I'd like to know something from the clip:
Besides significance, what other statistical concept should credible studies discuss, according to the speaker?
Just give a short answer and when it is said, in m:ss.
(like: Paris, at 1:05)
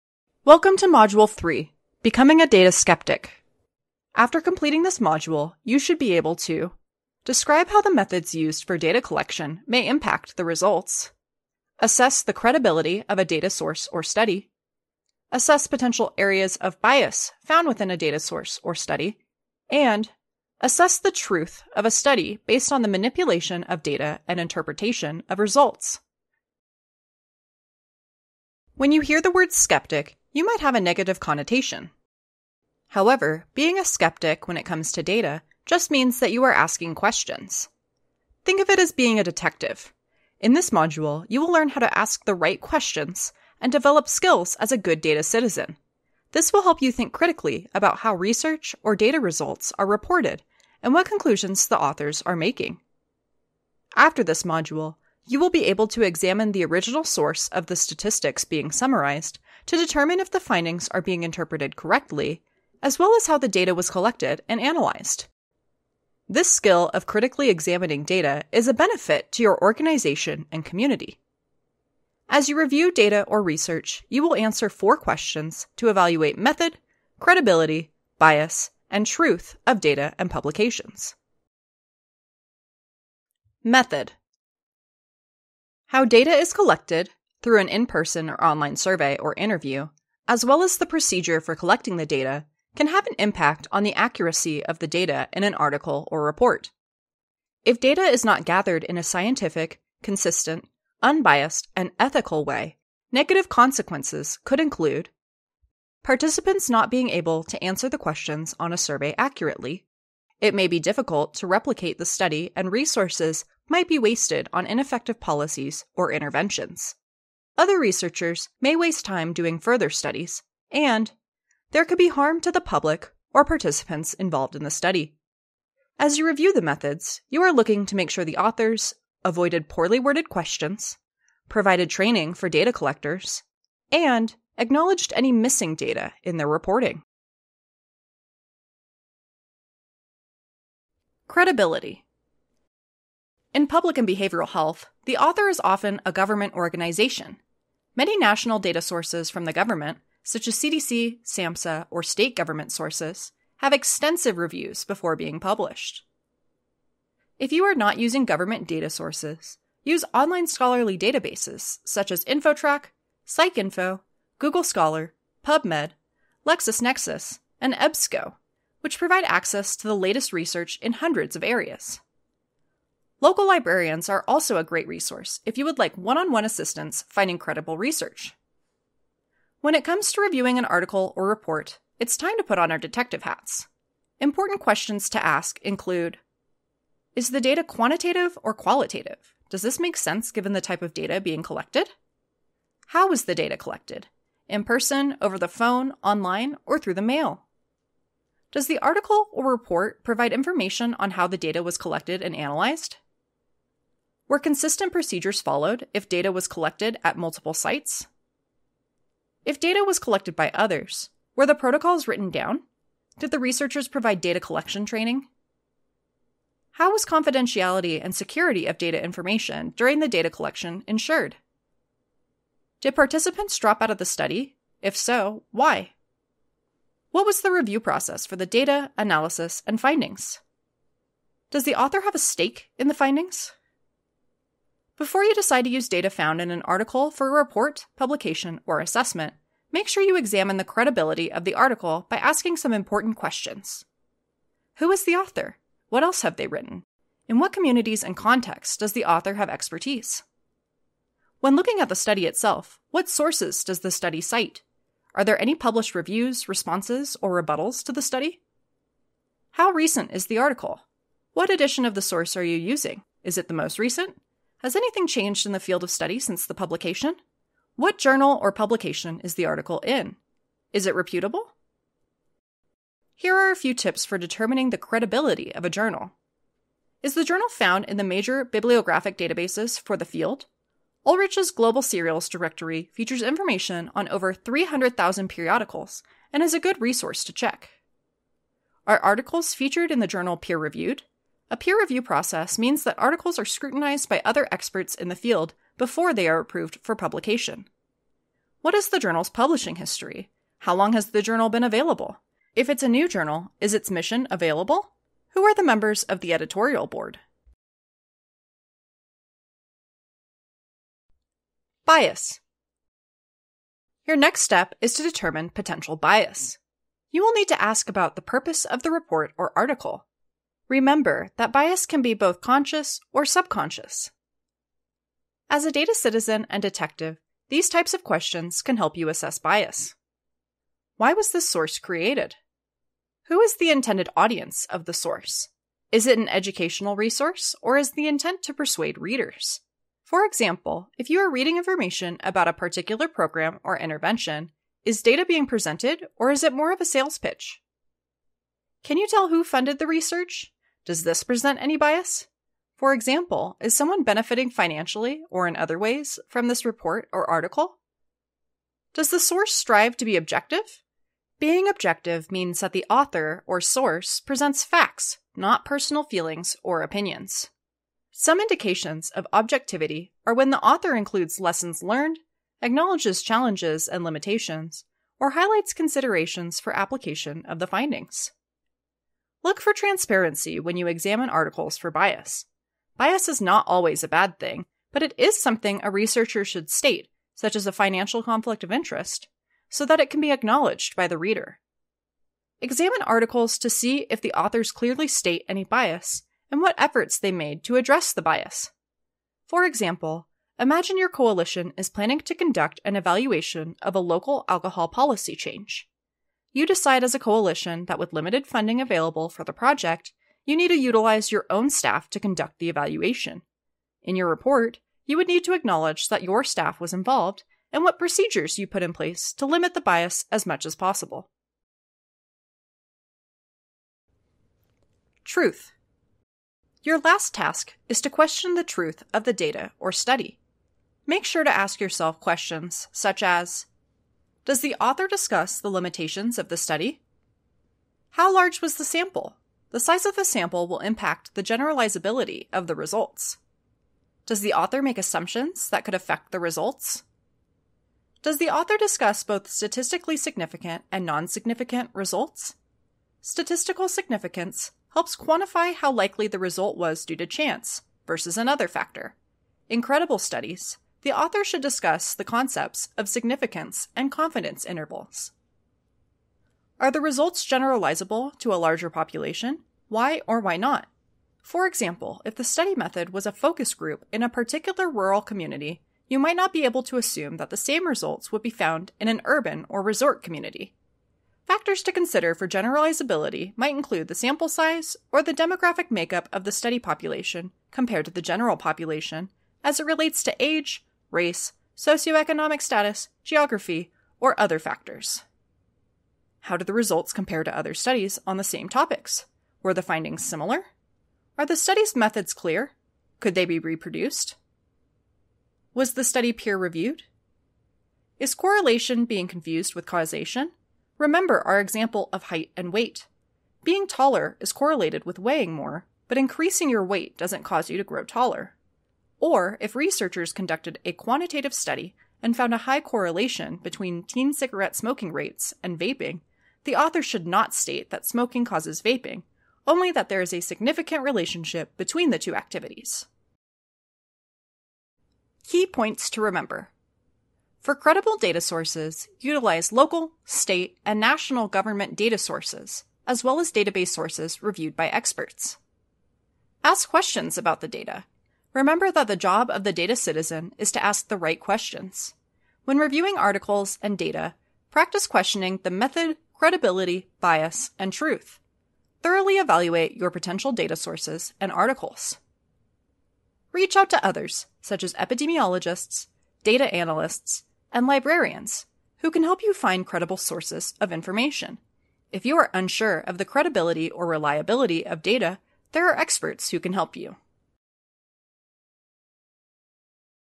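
Confidence intervals, at 7:44.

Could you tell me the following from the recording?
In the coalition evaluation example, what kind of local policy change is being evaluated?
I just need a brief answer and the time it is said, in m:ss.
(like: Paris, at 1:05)
Alcohol policy, at 6:43.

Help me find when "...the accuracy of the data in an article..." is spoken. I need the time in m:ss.
1:33.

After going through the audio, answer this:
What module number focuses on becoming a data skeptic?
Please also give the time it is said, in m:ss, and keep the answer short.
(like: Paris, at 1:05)
3, at 0:00.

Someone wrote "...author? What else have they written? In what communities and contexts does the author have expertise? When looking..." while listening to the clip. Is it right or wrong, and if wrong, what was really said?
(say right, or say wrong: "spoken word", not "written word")
right.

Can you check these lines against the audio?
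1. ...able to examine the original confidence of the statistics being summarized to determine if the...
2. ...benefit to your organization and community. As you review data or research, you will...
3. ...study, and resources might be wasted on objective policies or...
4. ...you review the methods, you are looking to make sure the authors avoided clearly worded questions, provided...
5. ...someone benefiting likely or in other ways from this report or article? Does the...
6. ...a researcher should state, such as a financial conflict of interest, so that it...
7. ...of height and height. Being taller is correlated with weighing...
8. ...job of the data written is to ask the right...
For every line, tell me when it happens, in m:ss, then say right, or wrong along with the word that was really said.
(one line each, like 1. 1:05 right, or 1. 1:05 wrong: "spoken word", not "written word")
1. 0:55 wrong: "source", not "confidence"
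2. 1:08 right
3. 1:52 wrong: "ineffective", not "objective"
4. 2:06 wrong: "poorly", not "clearly"
5. 5:53 wrong: "financially", not "likely"
6. 6:25 right
7. 8:32 wrong: "weight", not "height"
8. 9:09 wrong: "citizen", not "written".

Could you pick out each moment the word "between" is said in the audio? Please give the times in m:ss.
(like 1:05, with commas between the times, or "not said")
8:43, 8:51.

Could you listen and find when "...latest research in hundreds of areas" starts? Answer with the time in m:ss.
2:49.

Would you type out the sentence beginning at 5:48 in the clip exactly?
Can you tell who funded the research?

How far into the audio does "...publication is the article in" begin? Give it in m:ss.
4:28.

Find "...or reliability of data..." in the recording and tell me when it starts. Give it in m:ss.
9:33.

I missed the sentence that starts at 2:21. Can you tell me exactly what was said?
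Credibility in public and behavioral health, the author is often a government organization.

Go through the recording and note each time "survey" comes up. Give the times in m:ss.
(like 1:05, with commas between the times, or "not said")
1:28, 1:48.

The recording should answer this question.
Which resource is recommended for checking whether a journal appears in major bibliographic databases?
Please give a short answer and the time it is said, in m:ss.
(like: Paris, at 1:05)
Ulrich's Global Serials Directory, at 4:41.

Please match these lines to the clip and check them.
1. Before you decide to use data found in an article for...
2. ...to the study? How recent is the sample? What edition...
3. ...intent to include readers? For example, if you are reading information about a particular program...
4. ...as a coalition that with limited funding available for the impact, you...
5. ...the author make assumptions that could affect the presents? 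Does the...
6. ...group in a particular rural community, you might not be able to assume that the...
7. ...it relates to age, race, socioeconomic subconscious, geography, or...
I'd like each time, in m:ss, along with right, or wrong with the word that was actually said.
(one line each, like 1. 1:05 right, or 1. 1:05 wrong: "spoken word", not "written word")
1. 3:54 right
2. 4:17 wrong: "article", not "sample"
3. 5:38 wrong: "persuade", not "include"
4. 6:47 wrong: "project", not "impact"
5. 7:24 wrong: "results", not "presents"
6. 7:53 right
7. 8:09 wrong: "status", not "subconscious".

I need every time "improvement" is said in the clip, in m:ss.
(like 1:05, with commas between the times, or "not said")
not said.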